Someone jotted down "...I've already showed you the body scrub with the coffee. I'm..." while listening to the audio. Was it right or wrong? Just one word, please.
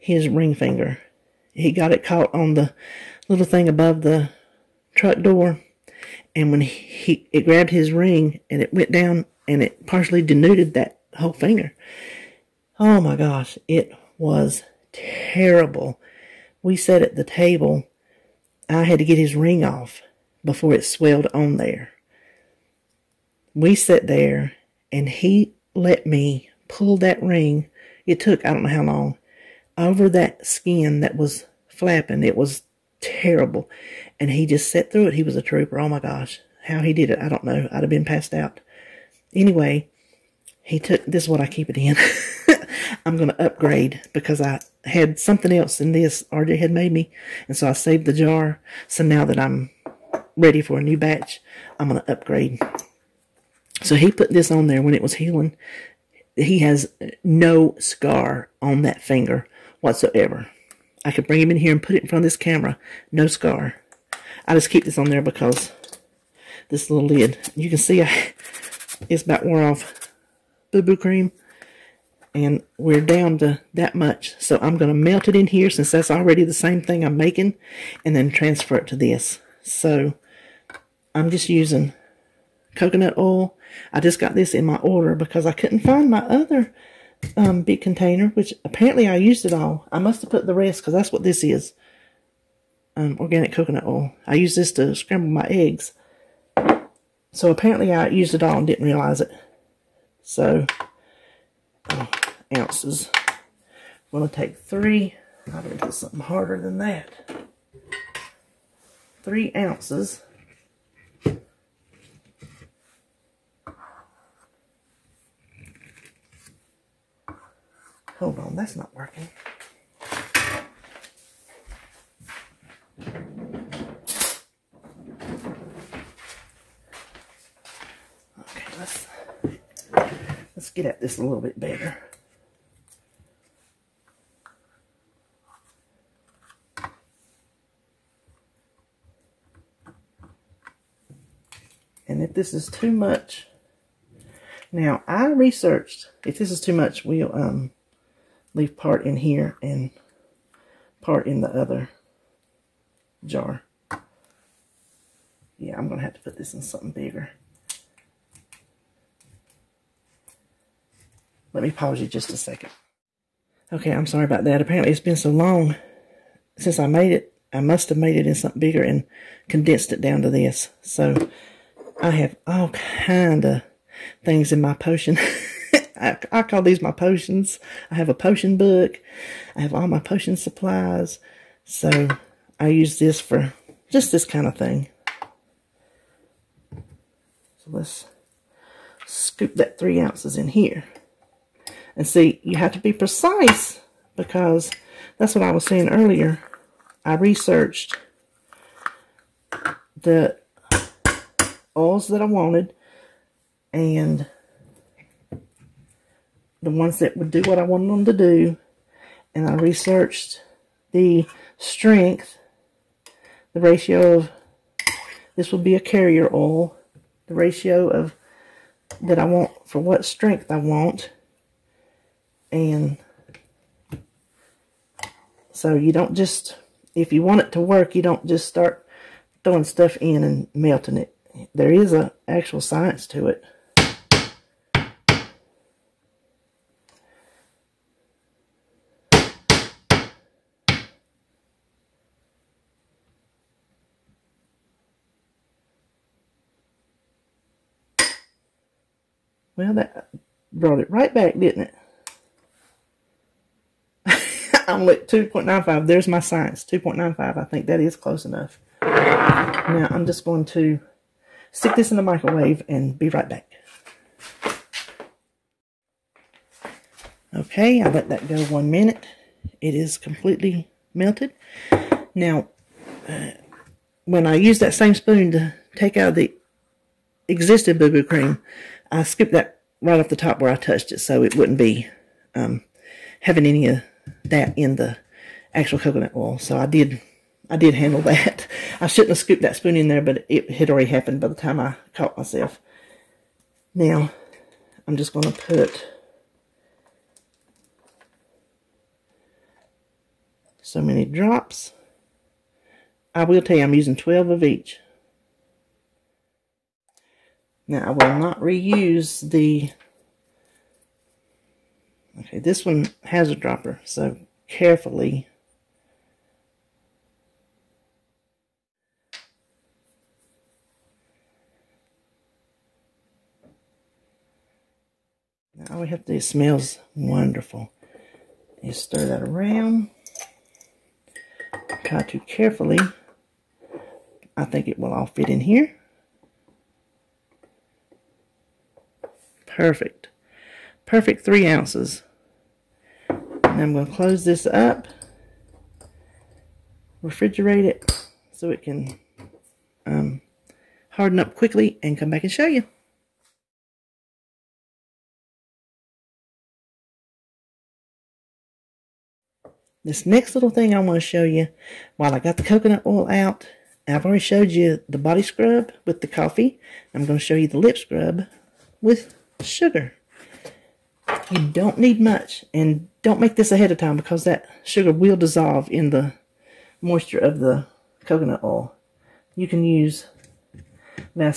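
right.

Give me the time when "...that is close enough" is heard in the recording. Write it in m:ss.
4:17.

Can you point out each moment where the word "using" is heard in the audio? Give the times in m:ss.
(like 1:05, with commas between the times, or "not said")
1:21, 5:03.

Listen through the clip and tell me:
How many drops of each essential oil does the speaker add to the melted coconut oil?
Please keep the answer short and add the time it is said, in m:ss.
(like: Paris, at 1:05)
12, at 5:03.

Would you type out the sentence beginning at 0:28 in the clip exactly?
It took, I don't know how long, over that skin that was flapping.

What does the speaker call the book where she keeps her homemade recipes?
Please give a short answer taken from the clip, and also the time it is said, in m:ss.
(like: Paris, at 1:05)
potion book, at 2:58.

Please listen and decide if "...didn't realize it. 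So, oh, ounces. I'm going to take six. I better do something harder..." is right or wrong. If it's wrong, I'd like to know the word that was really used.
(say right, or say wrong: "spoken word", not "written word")
wrong: "three", not "six".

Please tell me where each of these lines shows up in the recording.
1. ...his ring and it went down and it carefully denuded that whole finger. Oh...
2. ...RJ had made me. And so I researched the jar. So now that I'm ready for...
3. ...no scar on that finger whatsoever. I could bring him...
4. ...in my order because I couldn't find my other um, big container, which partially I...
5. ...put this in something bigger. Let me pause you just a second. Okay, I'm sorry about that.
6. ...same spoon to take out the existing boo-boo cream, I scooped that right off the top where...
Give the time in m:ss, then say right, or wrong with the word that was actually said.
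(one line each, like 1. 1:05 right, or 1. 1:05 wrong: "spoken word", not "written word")
1. 0:07 wrong: "partially", not "carefully"
2. 0:46 wrong: "saved", not "researched"
3. 0:57 right
4. 1:24 wrong: "apparently", not "partially"
5. 2:36 right
6. 4:34 right.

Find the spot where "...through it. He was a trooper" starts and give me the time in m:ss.
0:34.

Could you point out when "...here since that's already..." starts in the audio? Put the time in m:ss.
1:15.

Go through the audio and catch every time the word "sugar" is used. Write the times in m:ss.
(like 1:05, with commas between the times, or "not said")
6:09, 6:14.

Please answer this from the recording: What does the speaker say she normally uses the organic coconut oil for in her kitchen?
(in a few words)
scramble my eggs.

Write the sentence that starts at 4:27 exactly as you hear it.
Okay, I let that go one minute.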